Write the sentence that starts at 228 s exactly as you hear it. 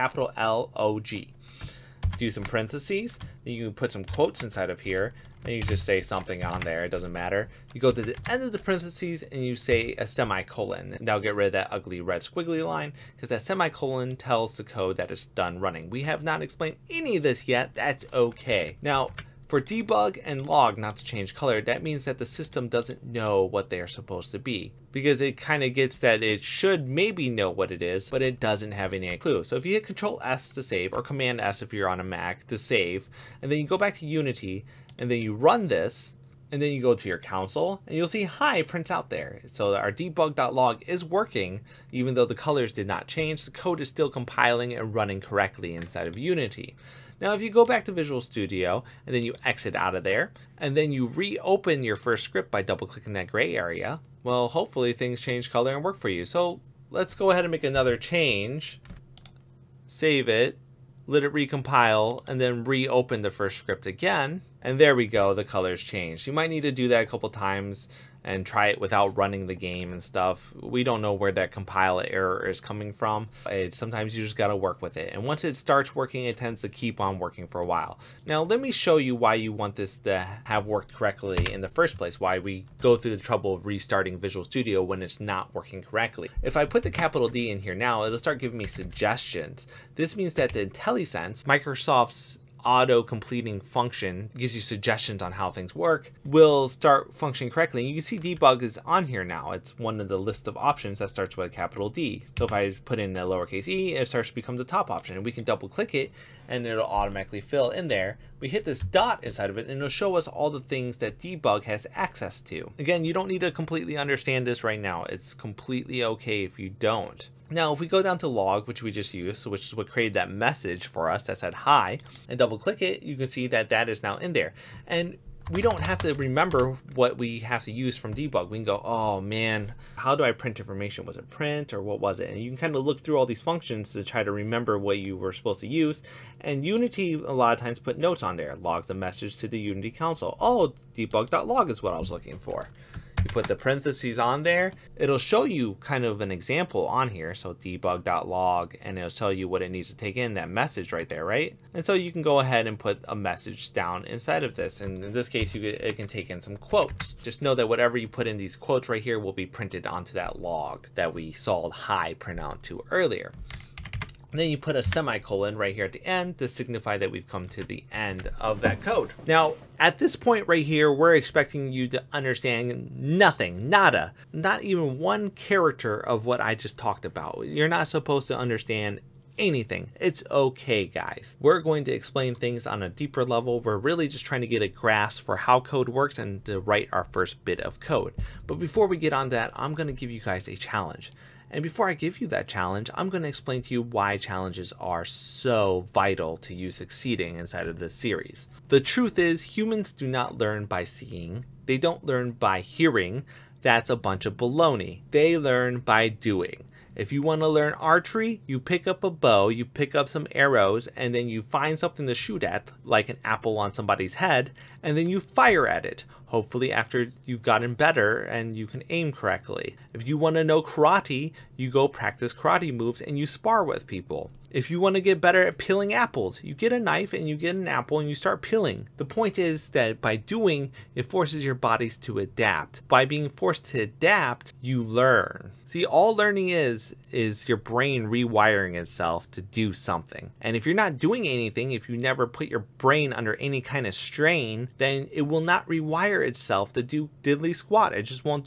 The point is that by doing, it forces your bodies to adapt.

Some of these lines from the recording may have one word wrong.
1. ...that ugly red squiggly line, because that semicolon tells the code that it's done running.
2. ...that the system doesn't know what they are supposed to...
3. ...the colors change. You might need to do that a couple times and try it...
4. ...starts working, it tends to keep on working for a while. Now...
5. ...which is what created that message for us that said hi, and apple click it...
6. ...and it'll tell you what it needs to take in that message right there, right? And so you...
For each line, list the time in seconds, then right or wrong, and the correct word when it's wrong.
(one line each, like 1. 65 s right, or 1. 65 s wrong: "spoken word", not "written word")
1. 11 s right
2. 22 s right
3. 65 s right
4. 75 s right
5. 119 s wrong: "double", not "apple"
6. 148 s right.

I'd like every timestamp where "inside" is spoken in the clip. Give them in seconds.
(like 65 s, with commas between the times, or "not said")
4 s, 45 s, 109 s, 154 s, 197 s.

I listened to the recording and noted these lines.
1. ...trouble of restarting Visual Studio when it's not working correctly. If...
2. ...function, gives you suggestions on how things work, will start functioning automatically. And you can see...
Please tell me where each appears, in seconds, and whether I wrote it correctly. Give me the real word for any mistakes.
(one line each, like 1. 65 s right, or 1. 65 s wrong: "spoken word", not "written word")
1. 83 s right
2. 93 s wrong: "correctly", not "automatically".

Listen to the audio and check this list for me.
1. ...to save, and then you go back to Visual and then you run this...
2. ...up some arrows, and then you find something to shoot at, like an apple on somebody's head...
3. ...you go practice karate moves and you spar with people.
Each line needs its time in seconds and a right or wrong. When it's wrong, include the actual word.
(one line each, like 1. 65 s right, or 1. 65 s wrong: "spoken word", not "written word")
1. 32 s wrong: "Unity", not "Visual"
2. 209 s right
3. 221 s right.